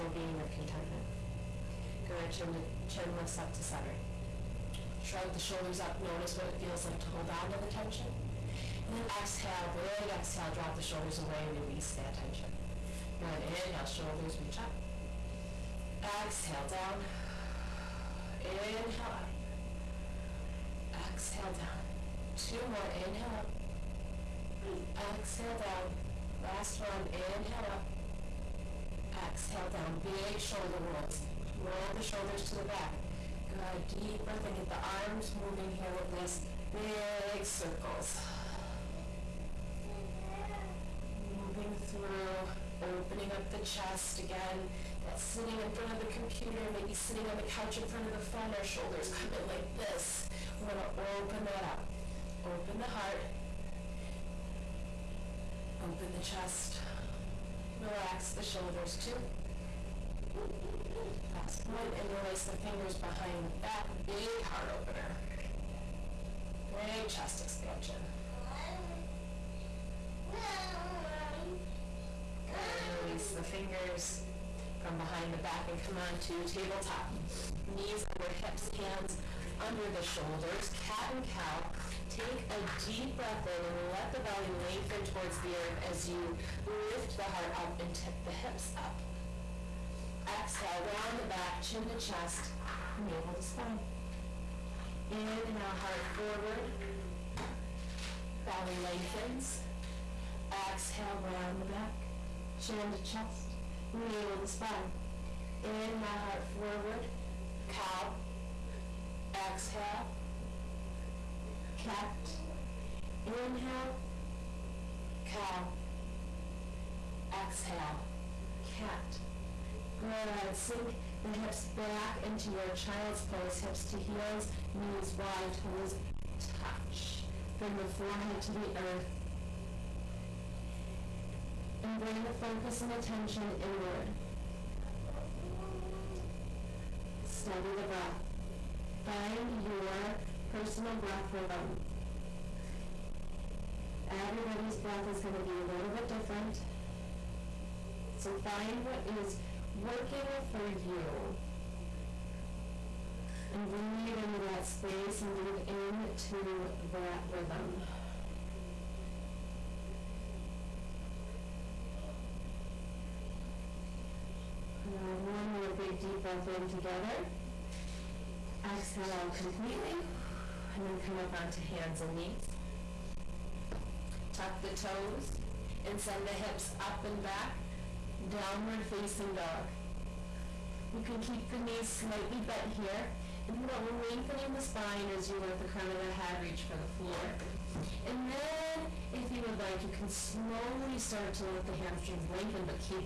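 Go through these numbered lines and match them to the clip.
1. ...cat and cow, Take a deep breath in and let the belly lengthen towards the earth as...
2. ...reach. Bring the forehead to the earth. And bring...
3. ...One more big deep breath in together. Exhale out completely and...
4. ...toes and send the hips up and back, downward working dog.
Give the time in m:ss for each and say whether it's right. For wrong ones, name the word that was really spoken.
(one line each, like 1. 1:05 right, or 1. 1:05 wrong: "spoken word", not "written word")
1. 1:20 right
2. 2:06 wrong: "touch", not "reach"
3. 2:45 right
4. 2:54 wrong: "facing", not "working".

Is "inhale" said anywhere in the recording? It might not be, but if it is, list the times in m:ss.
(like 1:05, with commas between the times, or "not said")
0:13, 0:18, 0:22, 0:27, 1:35, 1:45, 1:53.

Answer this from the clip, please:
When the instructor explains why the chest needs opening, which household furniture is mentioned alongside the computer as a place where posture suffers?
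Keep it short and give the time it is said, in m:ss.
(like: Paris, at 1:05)
the couch, at 0:47.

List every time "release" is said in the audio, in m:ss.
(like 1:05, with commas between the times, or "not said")
0:11, 1:02, 1:13.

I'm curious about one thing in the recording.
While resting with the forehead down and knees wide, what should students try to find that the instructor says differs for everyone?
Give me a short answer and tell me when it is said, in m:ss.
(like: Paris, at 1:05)
personal breath rhythm, at 2:20.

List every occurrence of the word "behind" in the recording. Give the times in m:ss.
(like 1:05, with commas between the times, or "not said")
1:02, 1:14.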